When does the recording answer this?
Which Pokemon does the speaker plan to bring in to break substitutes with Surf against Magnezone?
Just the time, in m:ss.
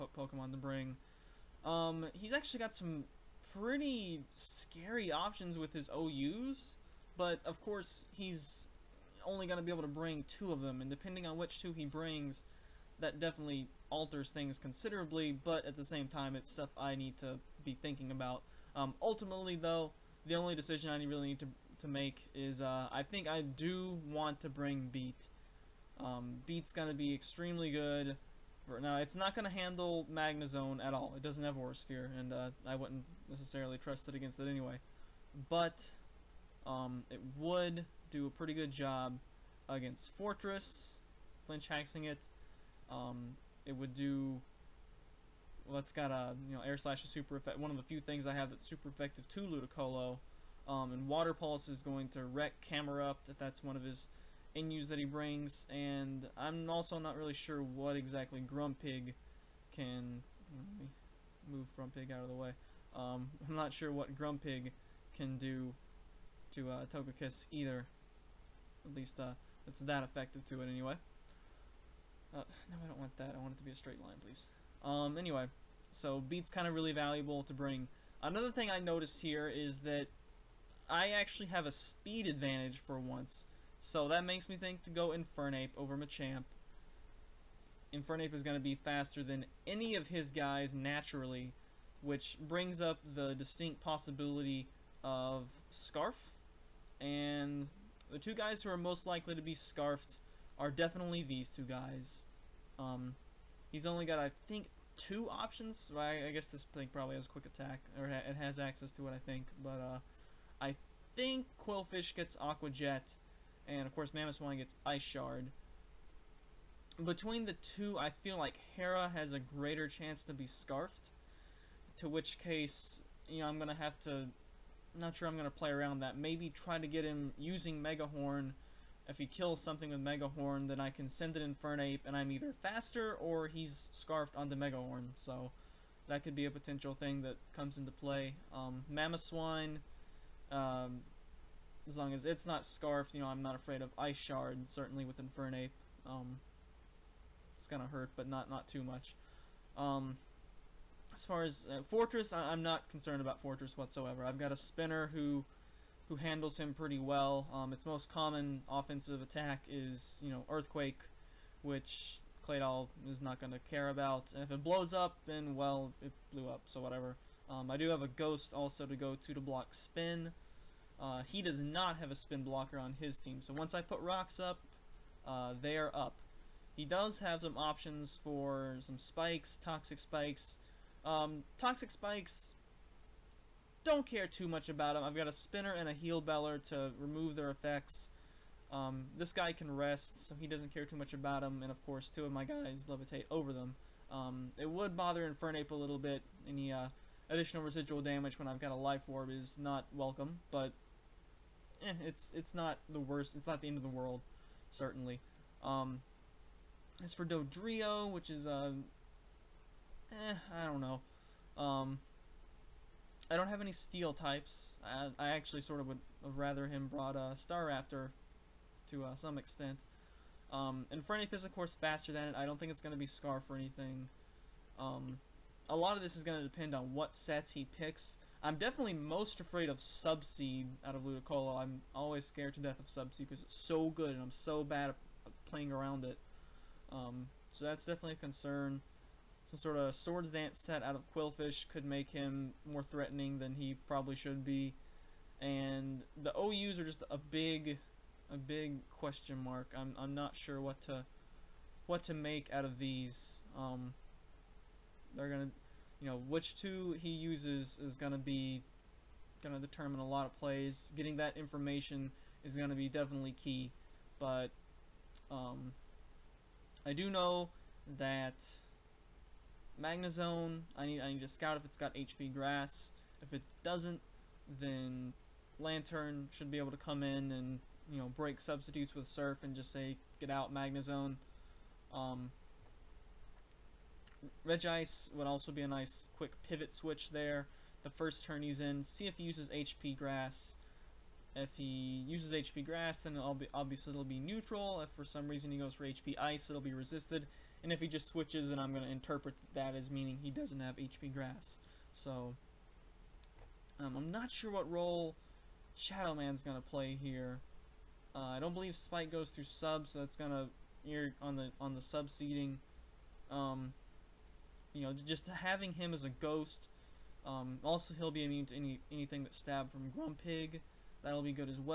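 4:35.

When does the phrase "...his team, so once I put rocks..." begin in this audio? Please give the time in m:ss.
2:52.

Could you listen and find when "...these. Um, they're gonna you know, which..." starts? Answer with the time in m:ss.
4:12.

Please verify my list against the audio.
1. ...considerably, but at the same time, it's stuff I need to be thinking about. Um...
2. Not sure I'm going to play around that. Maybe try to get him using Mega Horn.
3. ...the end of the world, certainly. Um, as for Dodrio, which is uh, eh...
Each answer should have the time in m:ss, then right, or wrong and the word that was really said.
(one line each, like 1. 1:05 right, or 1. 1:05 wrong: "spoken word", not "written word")
1. 0:14 right
2. 2:04 right
3. 3:23 right.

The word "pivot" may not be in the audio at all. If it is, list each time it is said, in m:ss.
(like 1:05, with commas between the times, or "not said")
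4:46.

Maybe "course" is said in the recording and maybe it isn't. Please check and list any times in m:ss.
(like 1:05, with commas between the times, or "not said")
0:07, 1:53, 3:11, 3:41.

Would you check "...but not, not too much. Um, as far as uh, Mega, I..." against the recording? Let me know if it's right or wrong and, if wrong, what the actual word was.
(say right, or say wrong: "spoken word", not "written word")
wrong: "Forretress", not "Mega".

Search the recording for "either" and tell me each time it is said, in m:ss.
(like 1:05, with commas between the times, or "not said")
1:07, 2:12.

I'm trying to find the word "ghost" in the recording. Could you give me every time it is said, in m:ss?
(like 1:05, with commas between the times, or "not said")
2:48, 5:16.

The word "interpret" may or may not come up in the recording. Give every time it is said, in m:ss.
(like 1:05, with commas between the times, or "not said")
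4:58.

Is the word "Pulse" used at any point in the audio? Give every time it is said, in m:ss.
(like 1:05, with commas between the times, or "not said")
0:51.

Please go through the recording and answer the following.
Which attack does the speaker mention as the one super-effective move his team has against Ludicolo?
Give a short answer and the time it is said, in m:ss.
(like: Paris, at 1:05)
Air Slash, at 0:46.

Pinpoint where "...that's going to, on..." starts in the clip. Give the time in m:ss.
5:09.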